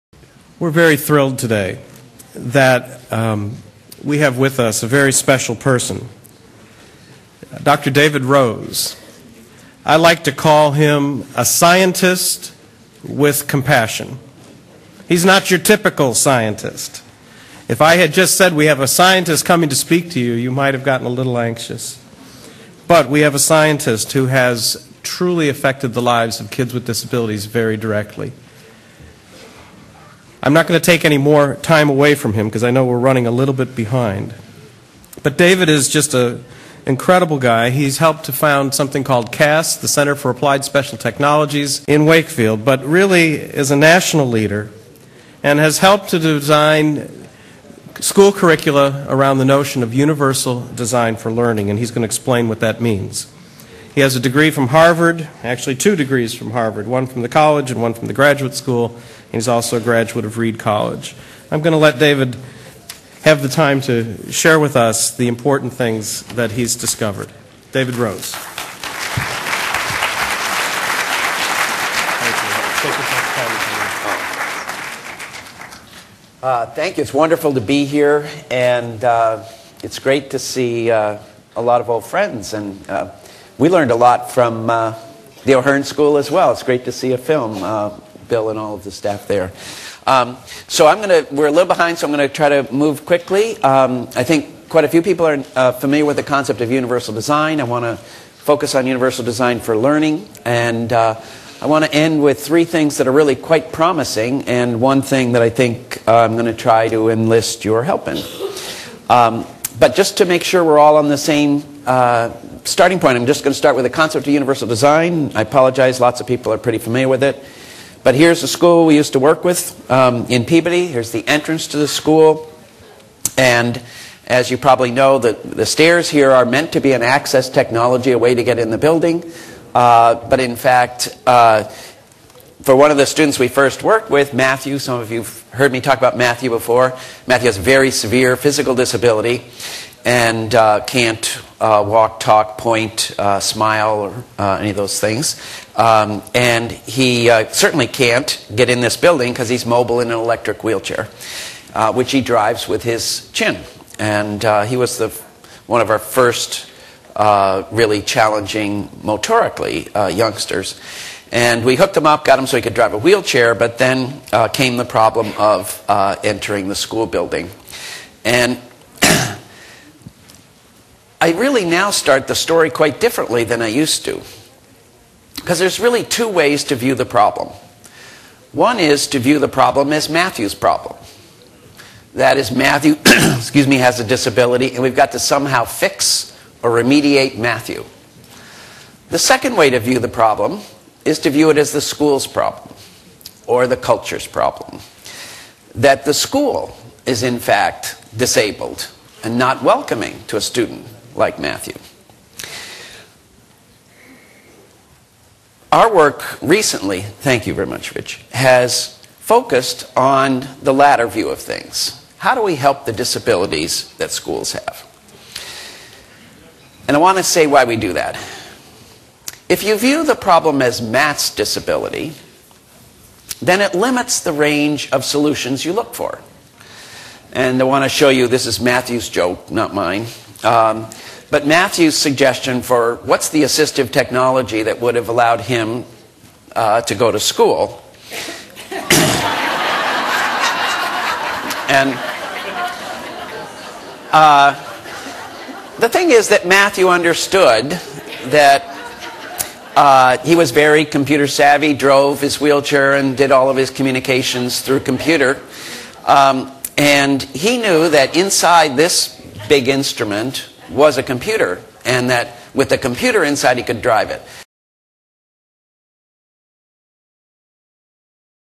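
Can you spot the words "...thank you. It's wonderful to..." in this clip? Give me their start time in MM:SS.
01:16.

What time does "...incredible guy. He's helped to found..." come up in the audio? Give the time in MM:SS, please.
00:36.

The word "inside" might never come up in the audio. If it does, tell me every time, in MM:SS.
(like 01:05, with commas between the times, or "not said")
04:18, 04:23.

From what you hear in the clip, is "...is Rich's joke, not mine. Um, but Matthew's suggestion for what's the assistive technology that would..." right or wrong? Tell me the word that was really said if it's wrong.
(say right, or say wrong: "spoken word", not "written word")
wrong: "Matthew", not "Rich".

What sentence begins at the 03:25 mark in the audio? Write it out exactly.
Our work recently, thank you very much, Rich, has focused on the latter view of things.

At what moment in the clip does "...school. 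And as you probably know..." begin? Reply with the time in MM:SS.
02:01.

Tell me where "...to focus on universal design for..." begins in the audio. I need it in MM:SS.
01:37.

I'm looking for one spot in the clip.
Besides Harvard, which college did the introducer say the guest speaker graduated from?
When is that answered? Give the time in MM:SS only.
01:00.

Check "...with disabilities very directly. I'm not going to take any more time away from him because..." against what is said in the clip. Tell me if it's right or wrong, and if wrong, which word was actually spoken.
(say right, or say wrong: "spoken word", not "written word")
right.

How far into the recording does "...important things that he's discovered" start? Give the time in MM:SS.
01:05.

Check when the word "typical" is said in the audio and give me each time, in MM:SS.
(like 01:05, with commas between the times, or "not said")
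00:15.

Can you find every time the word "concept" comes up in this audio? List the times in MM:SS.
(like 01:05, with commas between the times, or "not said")
01:36, 01:53.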